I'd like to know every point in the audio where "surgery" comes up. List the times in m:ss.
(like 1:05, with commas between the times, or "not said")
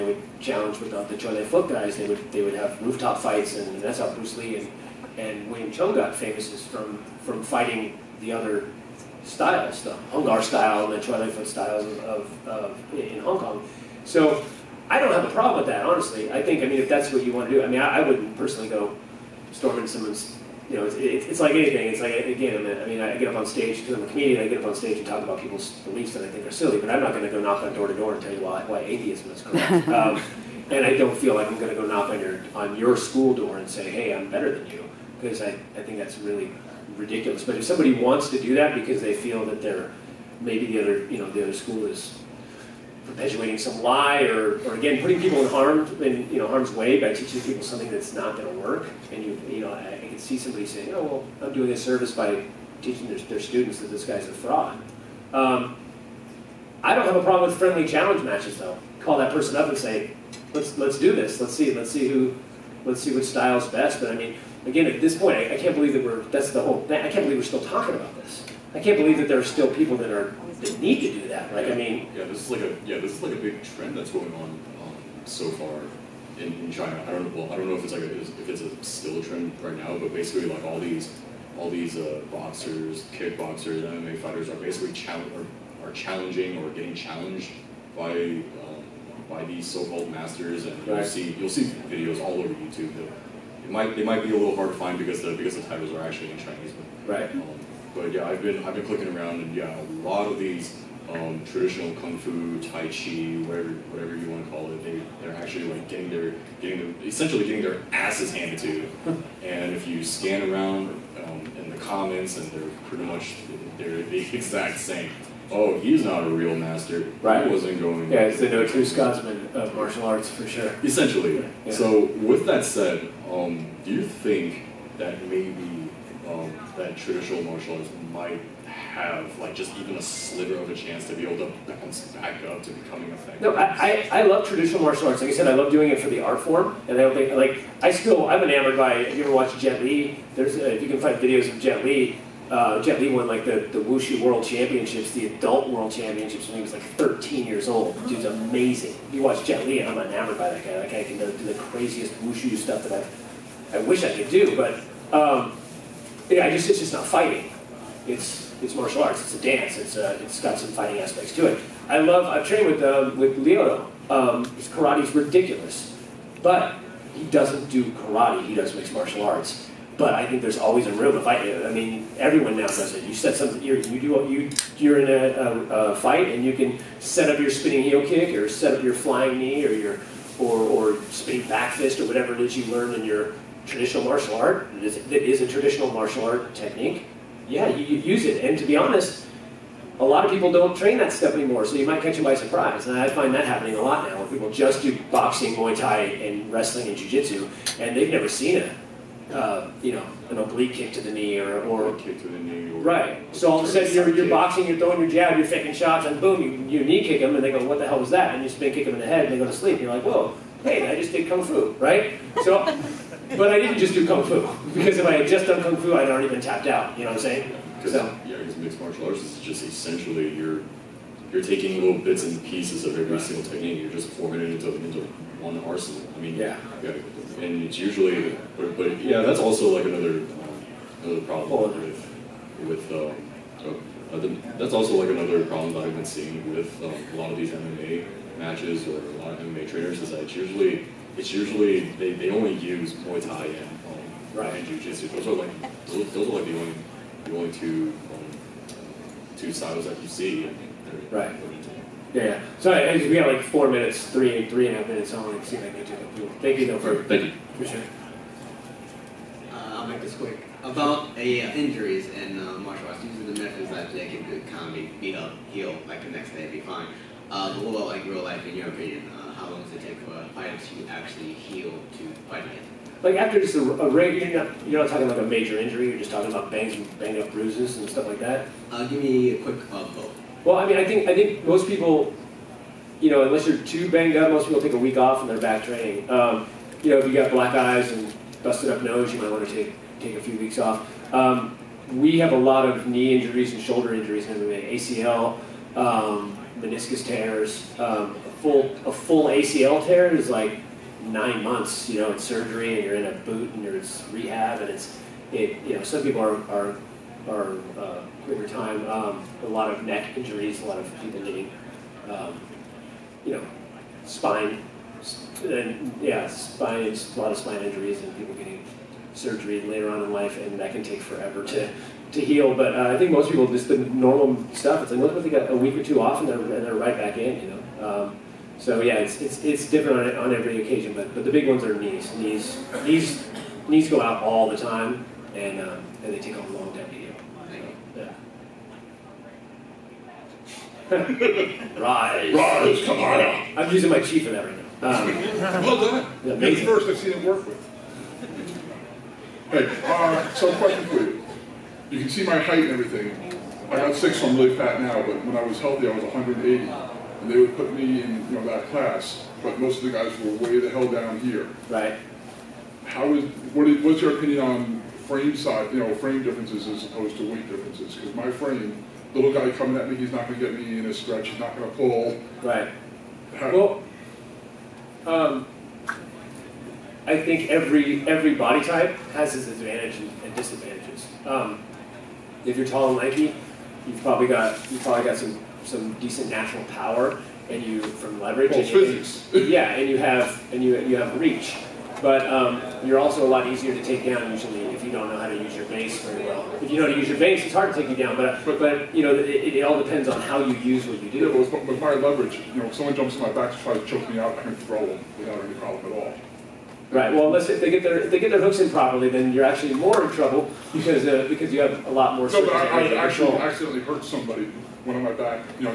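5:02, 5:19.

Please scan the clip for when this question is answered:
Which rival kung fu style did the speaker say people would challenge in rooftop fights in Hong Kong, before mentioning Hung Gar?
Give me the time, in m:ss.
0:01.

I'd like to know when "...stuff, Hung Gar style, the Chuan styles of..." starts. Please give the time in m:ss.
0:09.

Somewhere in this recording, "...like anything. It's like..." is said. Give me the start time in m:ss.
0:21.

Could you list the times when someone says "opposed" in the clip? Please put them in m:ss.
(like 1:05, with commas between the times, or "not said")
6:06.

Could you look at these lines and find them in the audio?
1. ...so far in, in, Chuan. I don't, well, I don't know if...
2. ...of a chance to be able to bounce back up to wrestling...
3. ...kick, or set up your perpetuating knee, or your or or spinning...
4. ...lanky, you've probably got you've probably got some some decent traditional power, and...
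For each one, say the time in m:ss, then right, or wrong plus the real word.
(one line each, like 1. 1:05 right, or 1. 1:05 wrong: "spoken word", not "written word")
1. 1:15 wrong: "China", not "Chuan"
2. 2:10 wrong: "becoming", not "wrestling"
3. 2:58 wrong: "flying", not "perpetuating"
4. 6:22 wrong: "natural", not "traditional".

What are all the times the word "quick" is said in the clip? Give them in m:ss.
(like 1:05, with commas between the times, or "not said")
4:20, 4:39.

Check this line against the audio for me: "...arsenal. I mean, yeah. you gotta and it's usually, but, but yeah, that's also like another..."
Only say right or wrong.
right.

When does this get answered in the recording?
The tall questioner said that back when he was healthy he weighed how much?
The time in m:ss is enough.
5:56.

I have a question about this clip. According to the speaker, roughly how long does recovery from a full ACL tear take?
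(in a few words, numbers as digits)
9 months.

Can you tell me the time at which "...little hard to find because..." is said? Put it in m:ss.
1:34.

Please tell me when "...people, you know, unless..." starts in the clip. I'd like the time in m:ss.
4:41.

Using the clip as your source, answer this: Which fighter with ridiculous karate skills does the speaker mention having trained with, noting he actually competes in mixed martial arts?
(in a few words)
Lyoto.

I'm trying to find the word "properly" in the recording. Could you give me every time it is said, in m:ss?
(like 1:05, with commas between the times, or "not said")
6:48.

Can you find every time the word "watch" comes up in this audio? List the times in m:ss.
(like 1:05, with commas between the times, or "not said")
2:19, 2:29.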